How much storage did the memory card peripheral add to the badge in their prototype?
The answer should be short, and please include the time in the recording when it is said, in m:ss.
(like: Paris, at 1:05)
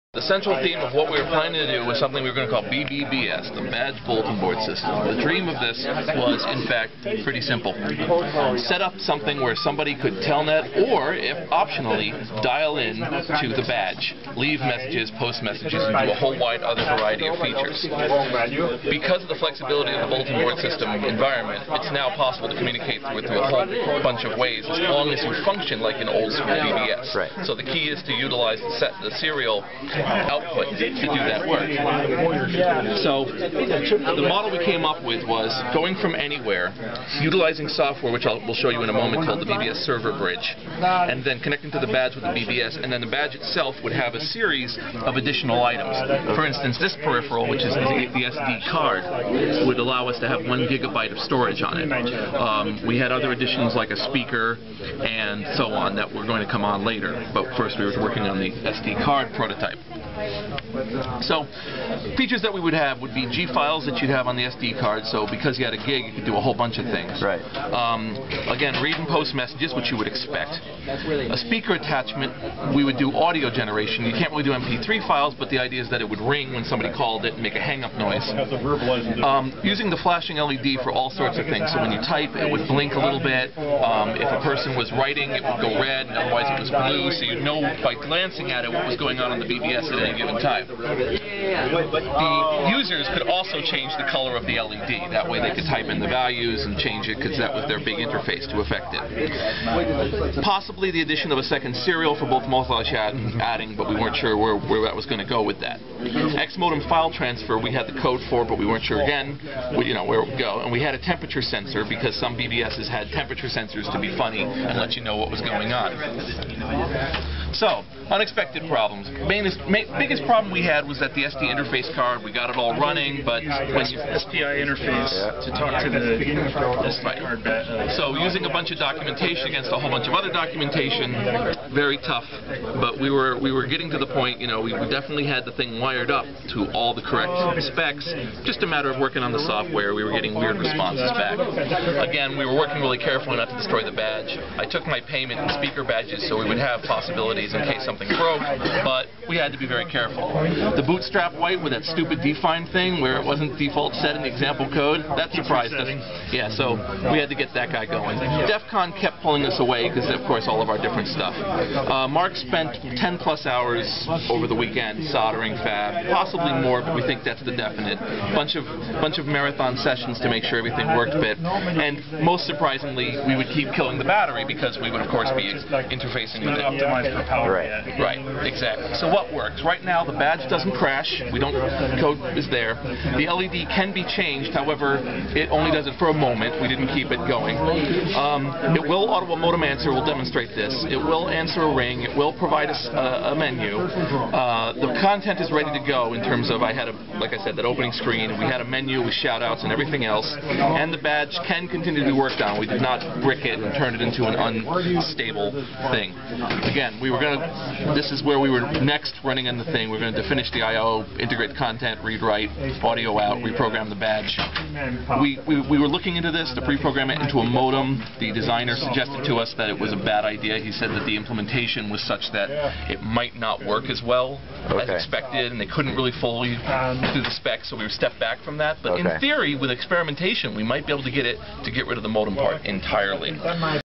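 1 gigabyte, at 0:50.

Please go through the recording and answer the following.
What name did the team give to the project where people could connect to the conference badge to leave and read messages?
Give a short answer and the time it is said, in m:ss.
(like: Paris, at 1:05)
Badge Bulletin Board System, at 0:03.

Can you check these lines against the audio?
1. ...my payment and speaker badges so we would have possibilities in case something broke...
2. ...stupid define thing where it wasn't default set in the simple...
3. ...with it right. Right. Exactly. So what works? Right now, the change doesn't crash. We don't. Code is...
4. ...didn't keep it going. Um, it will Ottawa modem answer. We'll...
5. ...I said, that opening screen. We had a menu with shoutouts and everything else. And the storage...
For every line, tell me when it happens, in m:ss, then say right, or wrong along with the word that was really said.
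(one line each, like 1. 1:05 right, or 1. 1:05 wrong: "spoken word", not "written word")
1. 2:24 right
2. 2:31 wrong: "example", not "simple"
3. 2:56 wrong: "badge", not "change"
4. 3:06 right
5. 3:17 wrong: "badge", not "storage".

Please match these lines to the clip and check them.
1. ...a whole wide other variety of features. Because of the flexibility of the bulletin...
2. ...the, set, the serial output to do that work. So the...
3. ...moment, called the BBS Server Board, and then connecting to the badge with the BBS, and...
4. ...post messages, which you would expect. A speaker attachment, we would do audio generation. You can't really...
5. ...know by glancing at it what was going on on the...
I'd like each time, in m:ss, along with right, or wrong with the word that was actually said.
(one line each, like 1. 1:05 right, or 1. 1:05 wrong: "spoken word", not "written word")
1. 0:16 right
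2. 0:28 right
3. 0:38 wrong: "Bridge", not "Board"
4. 1:09 right
5. 1:27 right.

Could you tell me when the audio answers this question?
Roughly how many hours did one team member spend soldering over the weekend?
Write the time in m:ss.
2:42.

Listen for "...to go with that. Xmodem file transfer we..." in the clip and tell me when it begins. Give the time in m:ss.
1:45.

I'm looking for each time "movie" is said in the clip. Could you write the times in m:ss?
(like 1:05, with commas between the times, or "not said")
not said.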